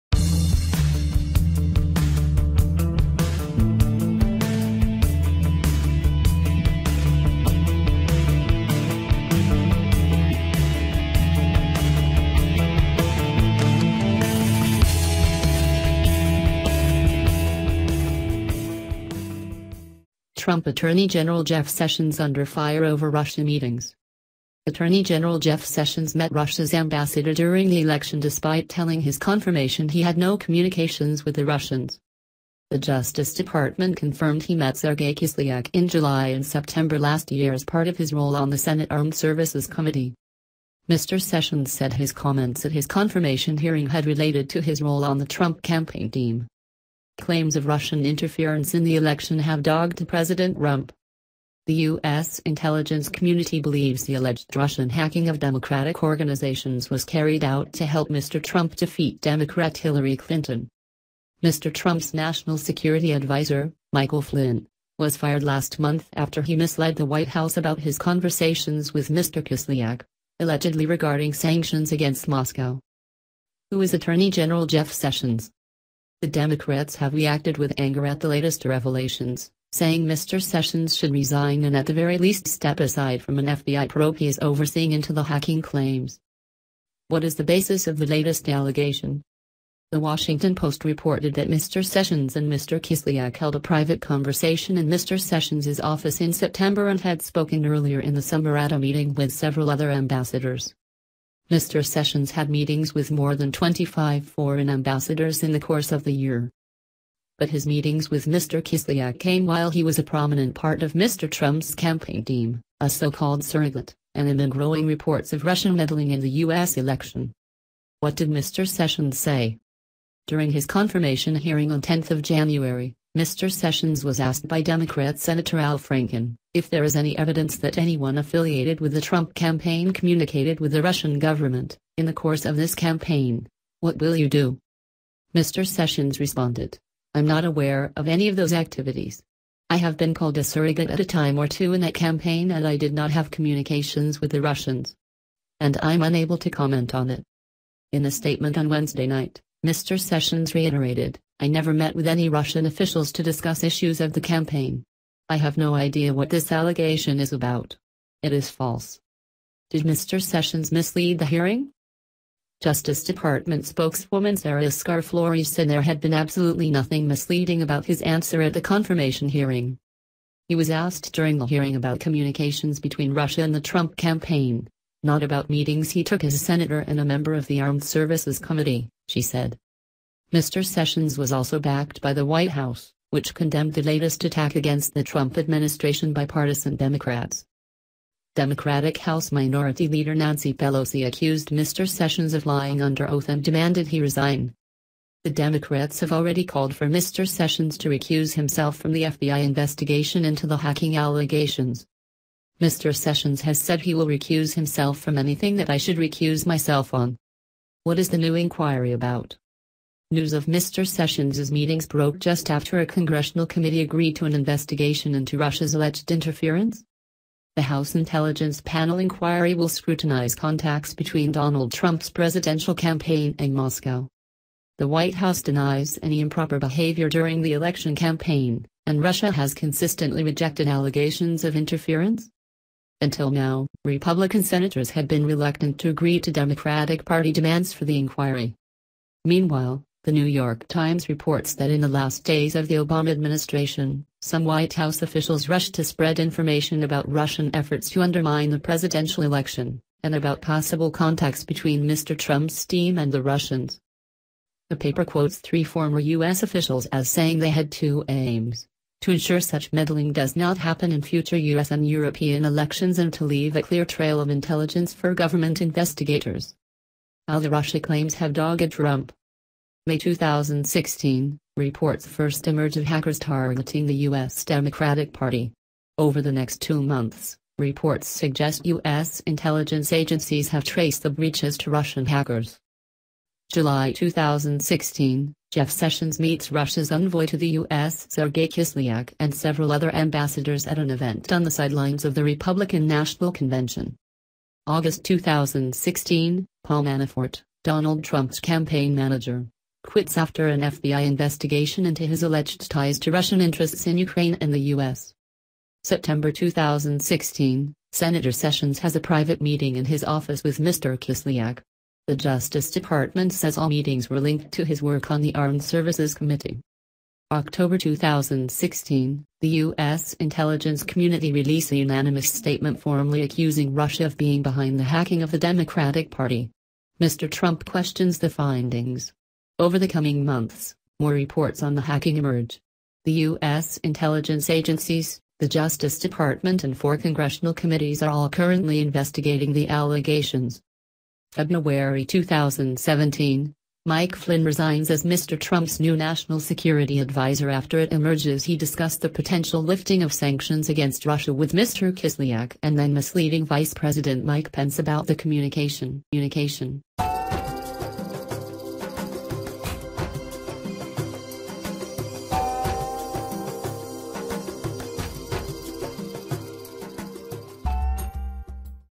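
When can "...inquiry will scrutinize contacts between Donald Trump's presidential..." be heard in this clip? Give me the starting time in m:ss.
3:38.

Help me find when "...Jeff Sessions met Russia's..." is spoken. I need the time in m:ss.
0:25.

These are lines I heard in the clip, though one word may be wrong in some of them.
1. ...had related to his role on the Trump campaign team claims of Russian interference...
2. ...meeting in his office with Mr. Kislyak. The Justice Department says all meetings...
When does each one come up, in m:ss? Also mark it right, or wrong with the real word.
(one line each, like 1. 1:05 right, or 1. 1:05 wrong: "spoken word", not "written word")
1. 0:43 right
2. 5:09 right.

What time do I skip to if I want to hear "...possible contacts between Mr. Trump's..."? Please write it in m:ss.
4:10.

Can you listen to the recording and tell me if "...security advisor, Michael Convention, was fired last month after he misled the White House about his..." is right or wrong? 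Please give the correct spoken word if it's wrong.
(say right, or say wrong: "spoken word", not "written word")
wrong: "Flynn", not "Convention".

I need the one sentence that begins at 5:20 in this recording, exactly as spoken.
intelligence community released a unanimous statement formally accusing Russia of being behind the hacking of the Democratic Party.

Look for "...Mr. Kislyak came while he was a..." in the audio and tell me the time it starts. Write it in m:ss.
1:48.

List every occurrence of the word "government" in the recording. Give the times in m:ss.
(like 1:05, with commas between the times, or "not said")
2:11, 4:25.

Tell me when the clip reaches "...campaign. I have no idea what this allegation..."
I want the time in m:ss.
2:34.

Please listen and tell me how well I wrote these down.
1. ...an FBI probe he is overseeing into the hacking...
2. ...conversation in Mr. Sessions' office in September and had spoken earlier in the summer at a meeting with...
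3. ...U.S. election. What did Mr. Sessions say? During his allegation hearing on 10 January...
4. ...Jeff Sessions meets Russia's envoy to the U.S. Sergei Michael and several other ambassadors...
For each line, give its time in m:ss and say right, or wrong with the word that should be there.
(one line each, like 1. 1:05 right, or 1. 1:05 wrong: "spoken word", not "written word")
1. 1:23 right
2. 1:34 right
3. 1:56 wrong: "confirmation", not "allegation"
4. 4:45 wrong: "Kislyak", not "Michael".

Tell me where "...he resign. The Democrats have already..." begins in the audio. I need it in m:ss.
3:13.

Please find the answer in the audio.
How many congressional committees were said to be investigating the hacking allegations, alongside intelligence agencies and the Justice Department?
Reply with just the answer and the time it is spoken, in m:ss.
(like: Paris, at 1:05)
4, at 5:36.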